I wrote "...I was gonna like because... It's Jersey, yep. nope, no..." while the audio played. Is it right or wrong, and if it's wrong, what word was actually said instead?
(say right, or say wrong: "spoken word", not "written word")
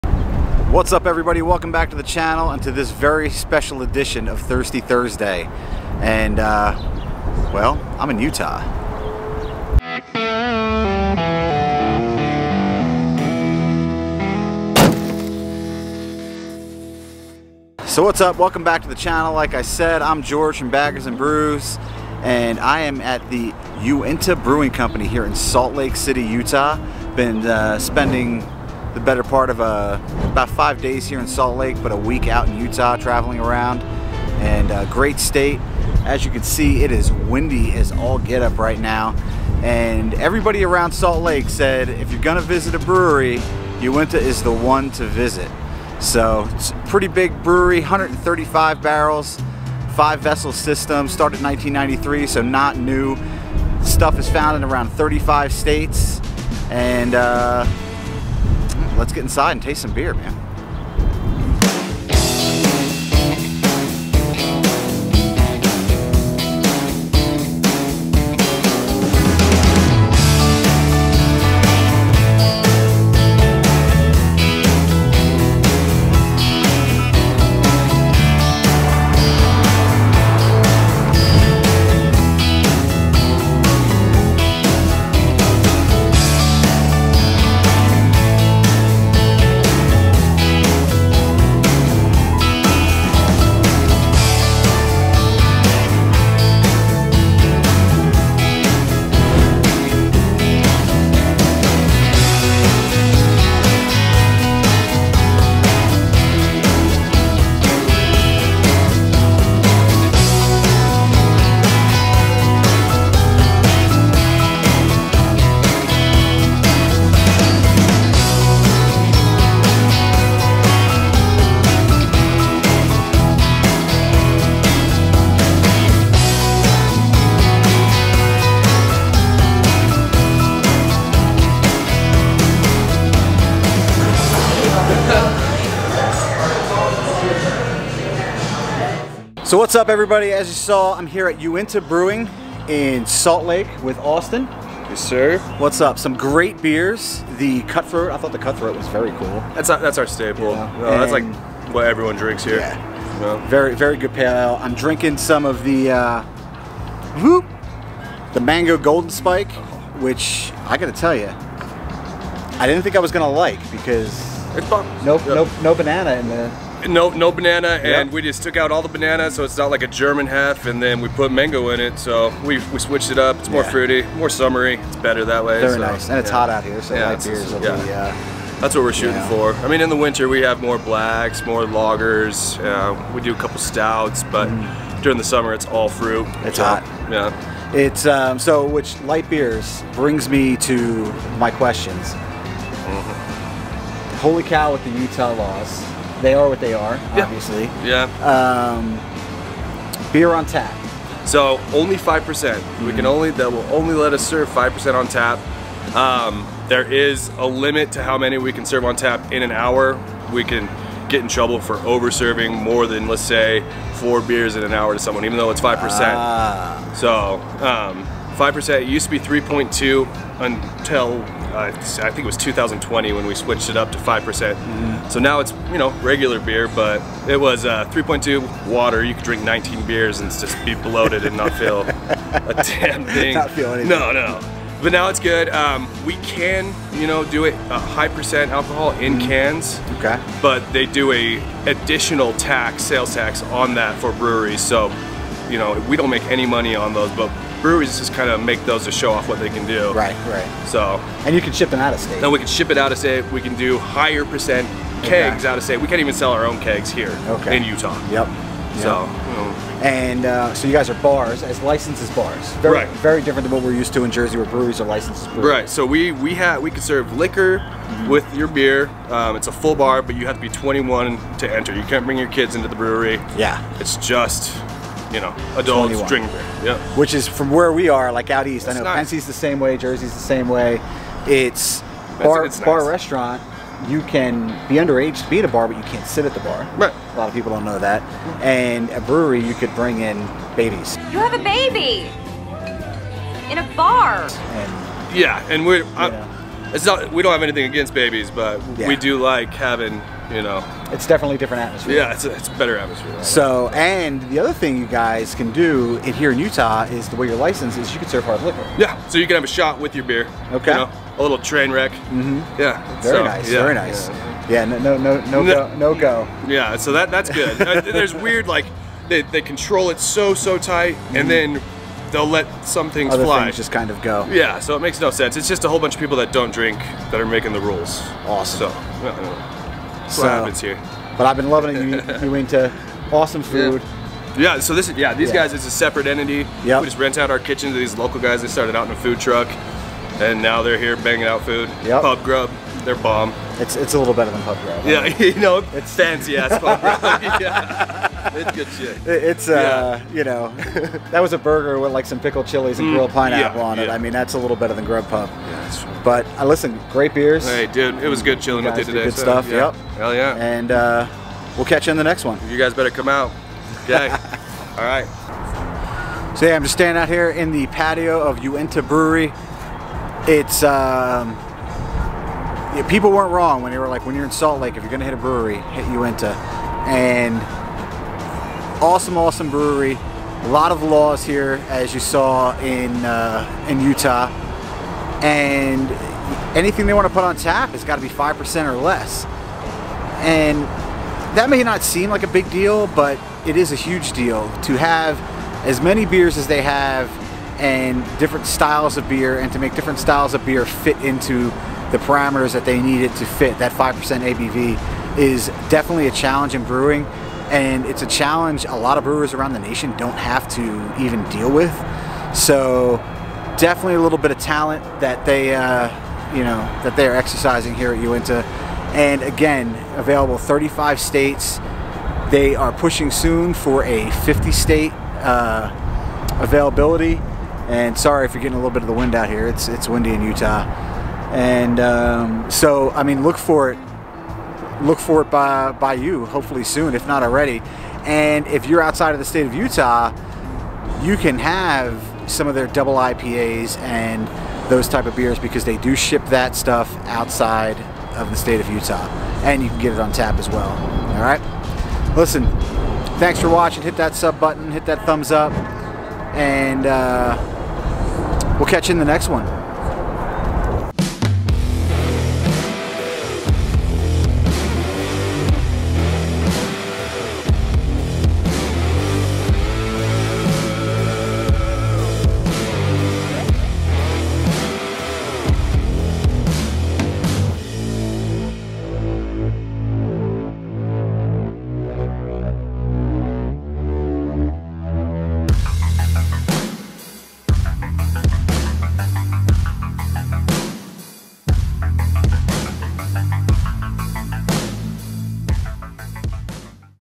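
wrong: "Nope", not "Jersey".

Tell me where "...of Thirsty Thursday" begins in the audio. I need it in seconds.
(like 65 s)
4 s.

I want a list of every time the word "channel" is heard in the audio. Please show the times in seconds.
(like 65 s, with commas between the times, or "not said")
2 s, 18 s.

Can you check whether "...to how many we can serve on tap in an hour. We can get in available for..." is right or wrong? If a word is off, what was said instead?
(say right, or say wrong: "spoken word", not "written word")
wrong: "trouble", not "available".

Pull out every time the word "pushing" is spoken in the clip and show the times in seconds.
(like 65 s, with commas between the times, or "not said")
422 s.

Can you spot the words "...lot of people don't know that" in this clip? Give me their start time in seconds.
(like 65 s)
287 s.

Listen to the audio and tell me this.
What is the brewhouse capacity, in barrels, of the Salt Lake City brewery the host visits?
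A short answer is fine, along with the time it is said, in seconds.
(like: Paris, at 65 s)
135 barrels, at 47 s.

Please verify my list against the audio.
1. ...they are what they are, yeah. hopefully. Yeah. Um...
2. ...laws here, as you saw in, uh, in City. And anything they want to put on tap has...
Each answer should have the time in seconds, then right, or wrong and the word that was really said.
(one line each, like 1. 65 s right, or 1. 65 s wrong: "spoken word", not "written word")
1. 196 s wrong: "obviously", not "hopefully"
2. 380 s wrong: "Utah", not "City".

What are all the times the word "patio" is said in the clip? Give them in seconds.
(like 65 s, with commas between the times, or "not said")
367 s.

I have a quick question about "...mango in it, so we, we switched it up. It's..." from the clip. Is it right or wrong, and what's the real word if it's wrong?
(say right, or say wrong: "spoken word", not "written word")
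right.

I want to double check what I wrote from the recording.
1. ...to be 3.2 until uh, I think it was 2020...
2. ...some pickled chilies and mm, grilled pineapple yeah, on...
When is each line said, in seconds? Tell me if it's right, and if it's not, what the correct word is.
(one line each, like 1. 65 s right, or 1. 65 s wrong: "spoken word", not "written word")
1. 219 s right
2. 352 s right.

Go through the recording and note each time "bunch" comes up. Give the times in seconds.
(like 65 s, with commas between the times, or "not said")
325 s.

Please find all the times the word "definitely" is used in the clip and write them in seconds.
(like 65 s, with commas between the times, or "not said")
301 s, 405 s, 413 s.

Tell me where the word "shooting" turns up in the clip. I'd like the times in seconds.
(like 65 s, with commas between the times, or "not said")
178 s.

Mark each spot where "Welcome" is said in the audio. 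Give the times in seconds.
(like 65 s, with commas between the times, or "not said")
1 s, 18 s.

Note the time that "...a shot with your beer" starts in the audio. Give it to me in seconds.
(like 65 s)
309 s.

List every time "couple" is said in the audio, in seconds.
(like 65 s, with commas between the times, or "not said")
183 s.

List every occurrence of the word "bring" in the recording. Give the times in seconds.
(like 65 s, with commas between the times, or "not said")
189 s, 272 s, 289 s.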